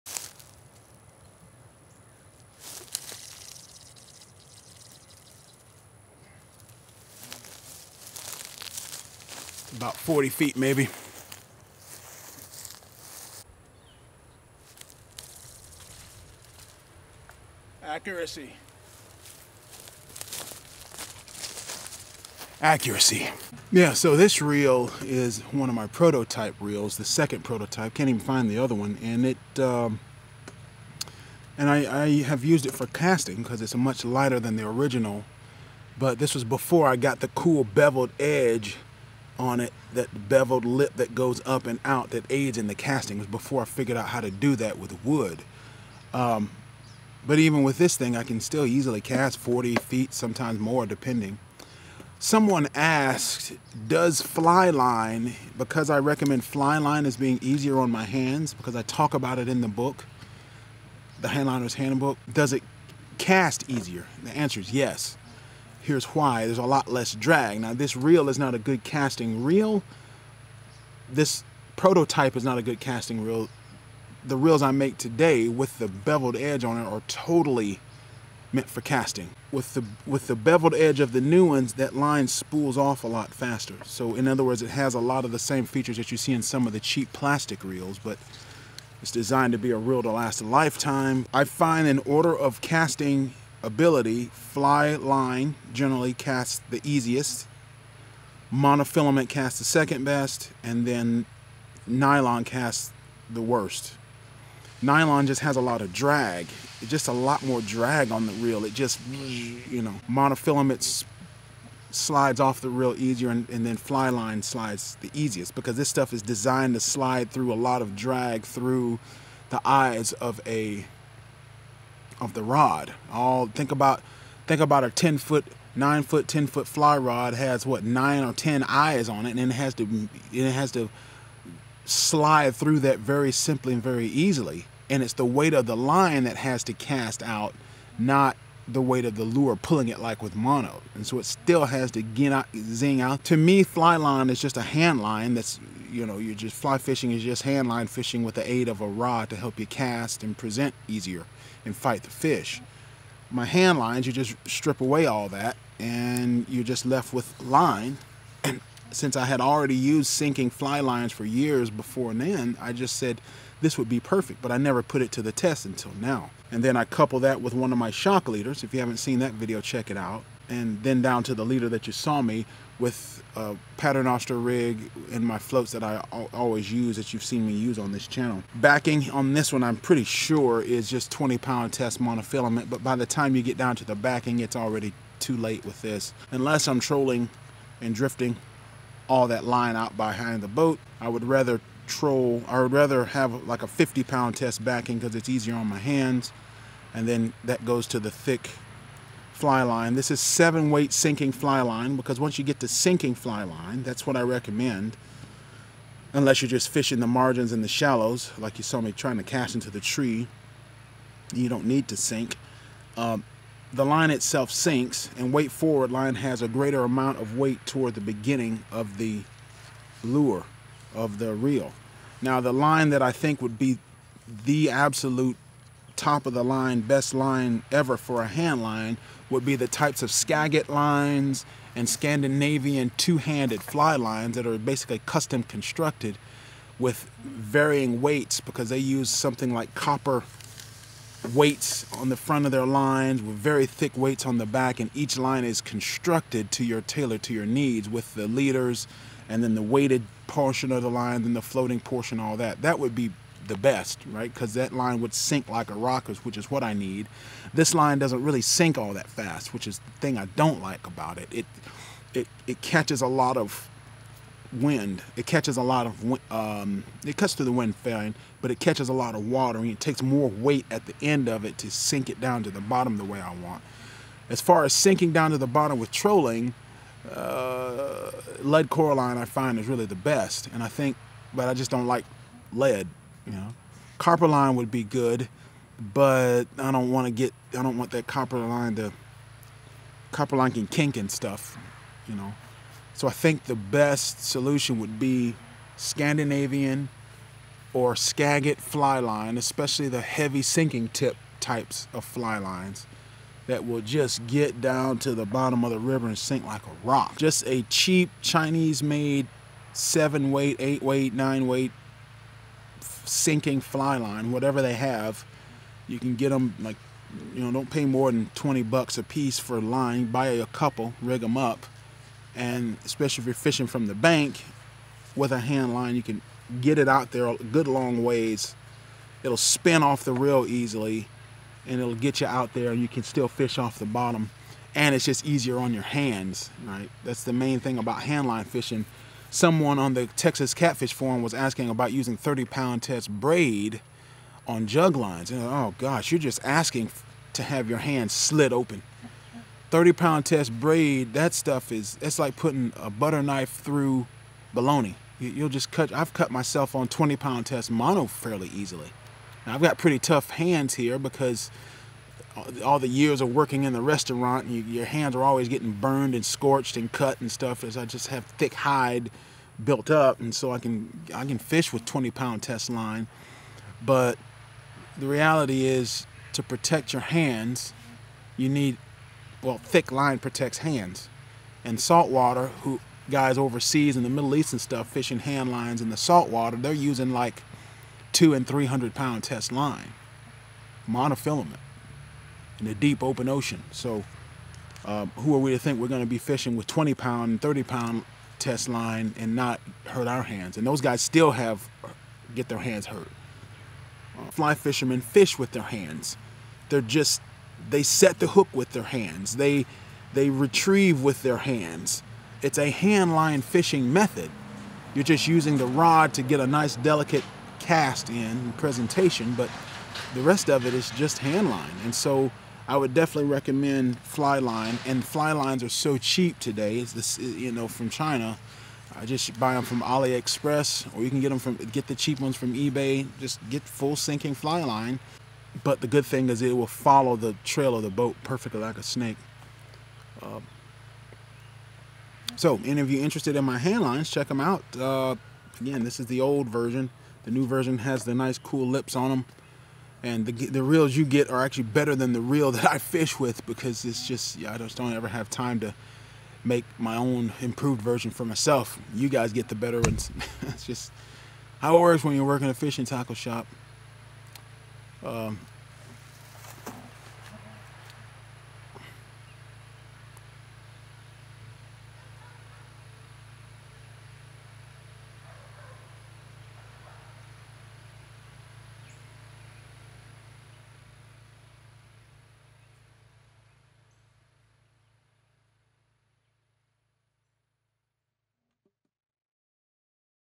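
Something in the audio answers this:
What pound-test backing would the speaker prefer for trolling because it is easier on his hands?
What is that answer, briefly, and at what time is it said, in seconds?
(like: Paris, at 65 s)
50 pound, at 193 s.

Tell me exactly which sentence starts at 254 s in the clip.
Because that line would sink like a rocket, which is what I need.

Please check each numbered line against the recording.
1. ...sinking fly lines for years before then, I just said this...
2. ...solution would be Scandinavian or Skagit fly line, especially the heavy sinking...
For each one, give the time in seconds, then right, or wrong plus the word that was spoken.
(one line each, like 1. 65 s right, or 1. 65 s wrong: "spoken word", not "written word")
1. 160 s right
2. 294 s right.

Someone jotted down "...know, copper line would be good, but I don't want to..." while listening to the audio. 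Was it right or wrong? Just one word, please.
right.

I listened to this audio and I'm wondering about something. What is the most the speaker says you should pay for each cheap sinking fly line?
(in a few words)
20 dollars.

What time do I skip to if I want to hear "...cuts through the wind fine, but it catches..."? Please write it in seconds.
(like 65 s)
267 s.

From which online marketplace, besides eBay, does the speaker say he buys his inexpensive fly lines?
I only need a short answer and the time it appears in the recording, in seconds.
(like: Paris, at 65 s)
AliExpress, at 429 s.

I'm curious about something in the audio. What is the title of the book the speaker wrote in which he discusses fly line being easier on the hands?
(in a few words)
The Handliner's Handbook.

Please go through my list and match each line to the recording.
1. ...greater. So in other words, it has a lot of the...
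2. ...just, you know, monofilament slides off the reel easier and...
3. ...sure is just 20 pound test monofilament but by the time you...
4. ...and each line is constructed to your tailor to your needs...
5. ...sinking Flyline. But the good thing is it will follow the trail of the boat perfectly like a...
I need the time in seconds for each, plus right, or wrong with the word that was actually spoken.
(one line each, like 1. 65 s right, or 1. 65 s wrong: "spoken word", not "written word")
1. 83 s wrong: "faster", not "greater"
2. 108 s right
3. 180 s right
4. 244 s right
5. 433 s right.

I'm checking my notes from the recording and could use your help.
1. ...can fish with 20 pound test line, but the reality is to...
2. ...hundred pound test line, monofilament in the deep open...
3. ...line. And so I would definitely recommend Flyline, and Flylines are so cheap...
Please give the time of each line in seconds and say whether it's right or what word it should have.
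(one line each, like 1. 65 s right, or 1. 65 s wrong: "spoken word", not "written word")
1. 371 s right
2. 388 s right
3. 421 s right.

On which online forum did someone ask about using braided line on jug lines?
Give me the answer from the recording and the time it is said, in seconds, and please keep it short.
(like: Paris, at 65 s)
Texas Catfish Forum, at 340 s.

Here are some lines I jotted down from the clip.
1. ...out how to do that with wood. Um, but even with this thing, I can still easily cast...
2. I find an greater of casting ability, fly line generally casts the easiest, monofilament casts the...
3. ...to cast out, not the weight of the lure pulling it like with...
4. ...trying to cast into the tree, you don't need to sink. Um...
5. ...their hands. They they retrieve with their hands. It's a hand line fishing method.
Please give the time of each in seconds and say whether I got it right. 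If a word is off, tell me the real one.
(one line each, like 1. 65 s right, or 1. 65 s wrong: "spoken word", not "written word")
1. 43 s right
2. 91 s wrong: "order", not "greater"
3. 136 s right
4. 208 s right
5. 408 s right.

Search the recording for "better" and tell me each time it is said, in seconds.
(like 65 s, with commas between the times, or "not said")
451 s, 459 s.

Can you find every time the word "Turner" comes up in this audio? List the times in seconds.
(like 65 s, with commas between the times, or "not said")
not said.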